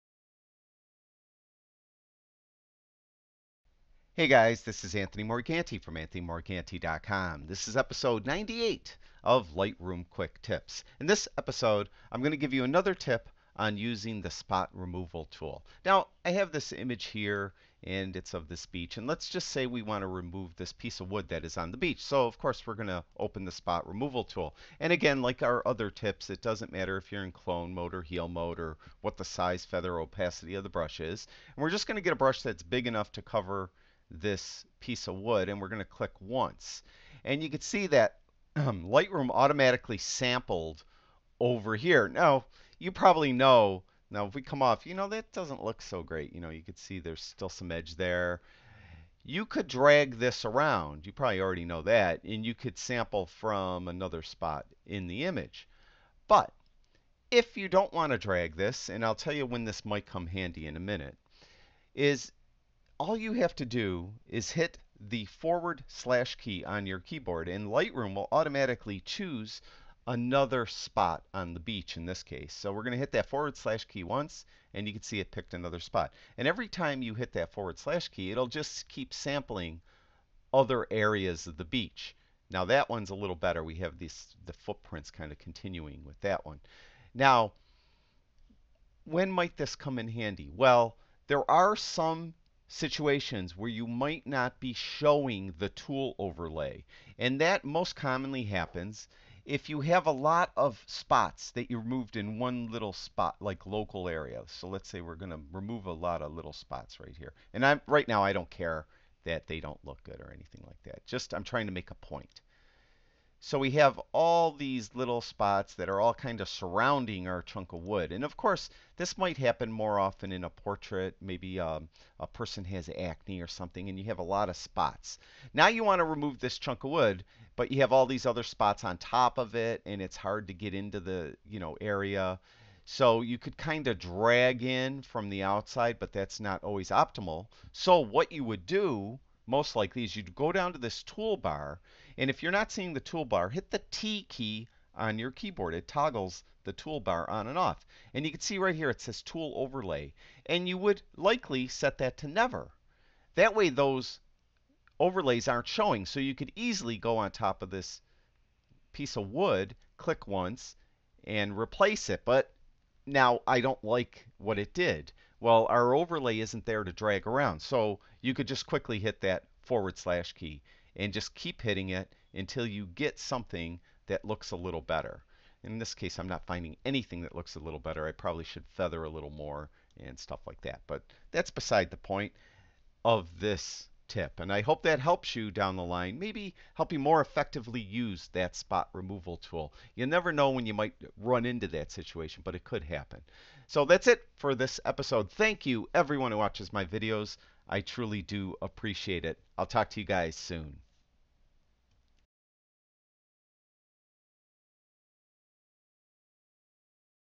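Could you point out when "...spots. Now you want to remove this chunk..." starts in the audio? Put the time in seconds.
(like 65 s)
124 s.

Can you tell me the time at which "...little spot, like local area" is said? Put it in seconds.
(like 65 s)
102 s.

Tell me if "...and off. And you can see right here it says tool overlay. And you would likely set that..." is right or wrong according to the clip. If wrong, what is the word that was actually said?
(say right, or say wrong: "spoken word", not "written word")
right.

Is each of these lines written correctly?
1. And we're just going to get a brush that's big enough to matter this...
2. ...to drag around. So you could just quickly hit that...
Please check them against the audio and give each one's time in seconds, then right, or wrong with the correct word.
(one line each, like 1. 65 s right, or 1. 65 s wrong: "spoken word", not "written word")
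1. 31 s wrong: "cover", not "matter"
2. 166 s right.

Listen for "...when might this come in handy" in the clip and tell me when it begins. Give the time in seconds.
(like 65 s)
89 s.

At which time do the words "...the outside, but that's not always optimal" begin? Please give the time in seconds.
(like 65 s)
135 s.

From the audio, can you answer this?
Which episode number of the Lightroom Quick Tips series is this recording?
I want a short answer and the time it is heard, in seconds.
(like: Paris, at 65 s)
98, at 7 s.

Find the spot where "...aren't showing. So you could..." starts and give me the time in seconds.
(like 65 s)
155 s.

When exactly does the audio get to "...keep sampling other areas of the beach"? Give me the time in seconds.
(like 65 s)
78 s.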